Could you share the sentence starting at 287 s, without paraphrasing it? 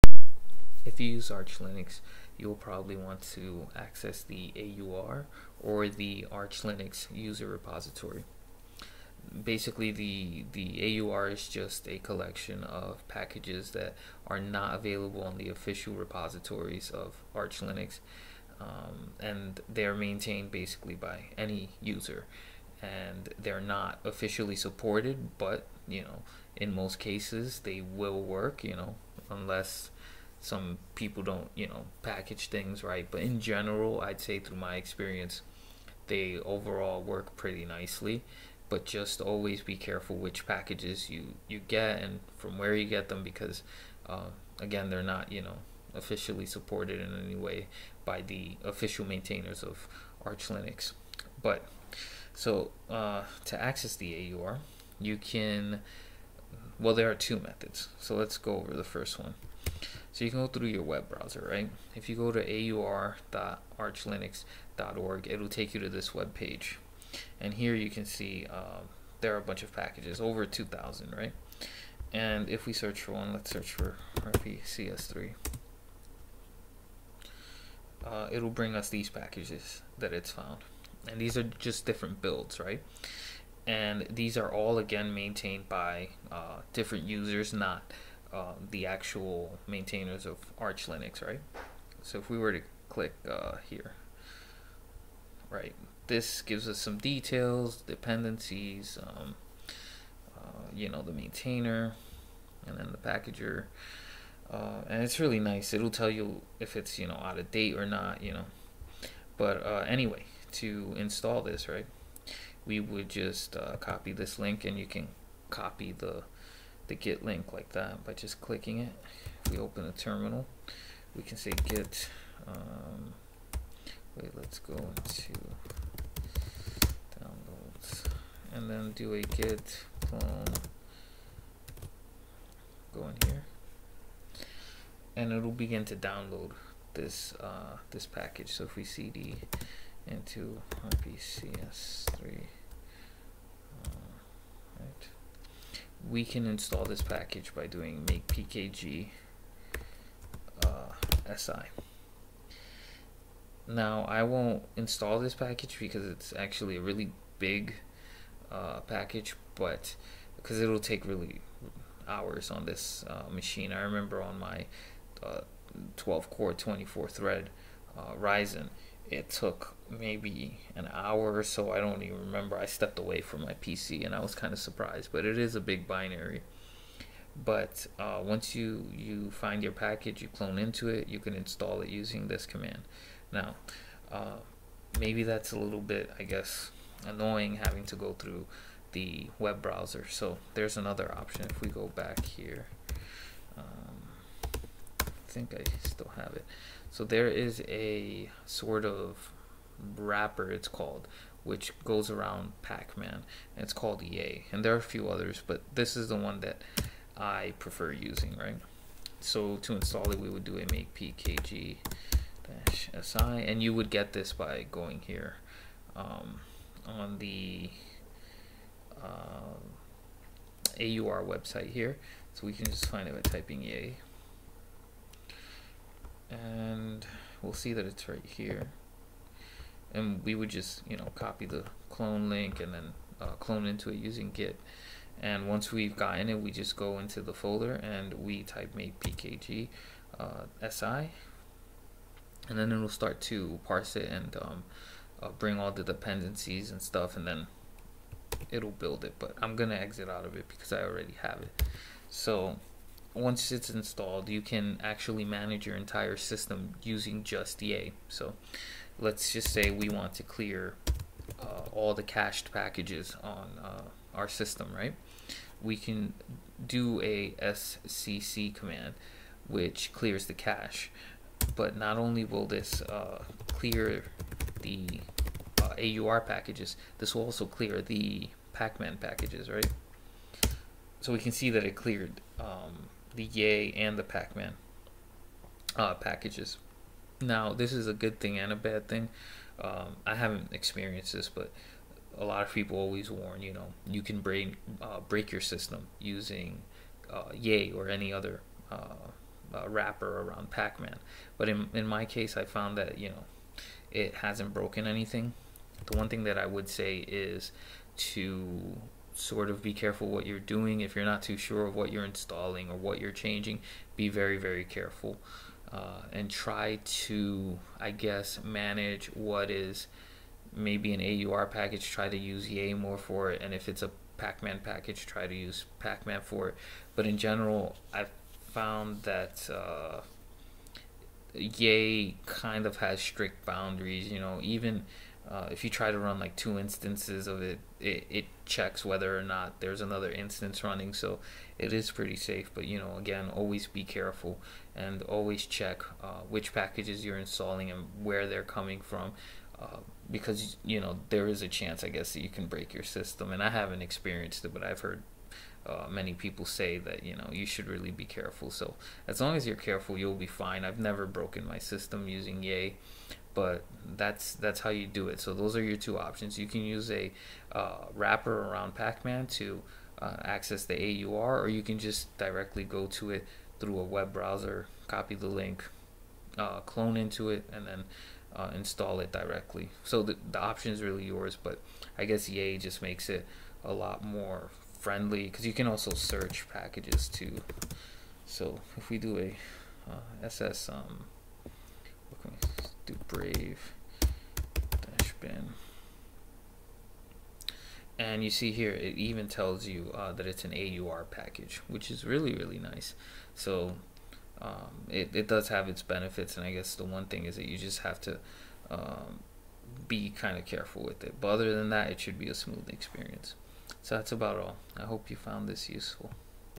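Now, this is a good thing and a bad thing.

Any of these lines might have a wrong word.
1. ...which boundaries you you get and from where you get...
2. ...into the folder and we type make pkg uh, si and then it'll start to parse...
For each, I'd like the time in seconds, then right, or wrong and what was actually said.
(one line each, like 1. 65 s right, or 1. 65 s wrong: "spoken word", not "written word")
1. 40 s wrong: "packages", not "boundaries"
2. 236 s right.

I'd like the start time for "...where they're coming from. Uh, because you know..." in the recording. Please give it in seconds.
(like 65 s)
348 s.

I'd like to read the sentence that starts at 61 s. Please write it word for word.
If you go to aur.archlinux.org, it'll take you to this web page.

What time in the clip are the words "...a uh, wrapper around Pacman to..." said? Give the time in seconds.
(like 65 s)
366 s.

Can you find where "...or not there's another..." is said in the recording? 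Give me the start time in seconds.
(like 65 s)
339 s.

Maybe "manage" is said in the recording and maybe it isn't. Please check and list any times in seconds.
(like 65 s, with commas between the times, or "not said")
255 s, 318 s.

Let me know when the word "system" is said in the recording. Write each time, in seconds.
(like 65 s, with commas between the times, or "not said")
256 s, 264 s, 295 s, 352 s, 361 s.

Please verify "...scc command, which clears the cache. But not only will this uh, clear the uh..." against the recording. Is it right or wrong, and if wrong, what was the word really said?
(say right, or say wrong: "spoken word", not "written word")
right.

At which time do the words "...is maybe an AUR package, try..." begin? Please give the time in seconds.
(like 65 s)
319 s.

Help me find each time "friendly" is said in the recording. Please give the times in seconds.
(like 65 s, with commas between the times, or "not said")
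384 s.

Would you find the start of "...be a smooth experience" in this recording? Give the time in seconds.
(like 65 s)
412 s.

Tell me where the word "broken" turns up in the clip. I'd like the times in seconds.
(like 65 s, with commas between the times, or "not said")
304 s, 361 s.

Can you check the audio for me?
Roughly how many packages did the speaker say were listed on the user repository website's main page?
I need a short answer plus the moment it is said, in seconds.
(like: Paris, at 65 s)
over 2,000, at 70 s.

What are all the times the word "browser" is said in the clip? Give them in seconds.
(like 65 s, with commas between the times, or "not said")
61 s, 189 s, 374 s.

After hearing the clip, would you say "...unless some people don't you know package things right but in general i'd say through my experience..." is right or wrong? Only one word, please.
right.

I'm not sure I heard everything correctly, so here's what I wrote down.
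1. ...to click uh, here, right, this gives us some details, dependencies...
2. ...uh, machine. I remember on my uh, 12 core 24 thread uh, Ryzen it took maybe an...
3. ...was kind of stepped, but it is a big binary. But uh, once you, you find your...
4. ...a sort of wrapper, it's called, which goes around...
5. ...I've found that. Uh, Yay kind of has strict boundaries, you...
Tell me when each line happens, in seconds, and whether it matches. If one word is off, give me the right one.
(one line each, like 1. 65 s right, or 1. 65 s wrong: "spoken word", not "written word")
1. 92 s right
2. 163 s right
3. 174 s wrong: "surprised", not "stepped"
4. 197 s right
5. 327 s right.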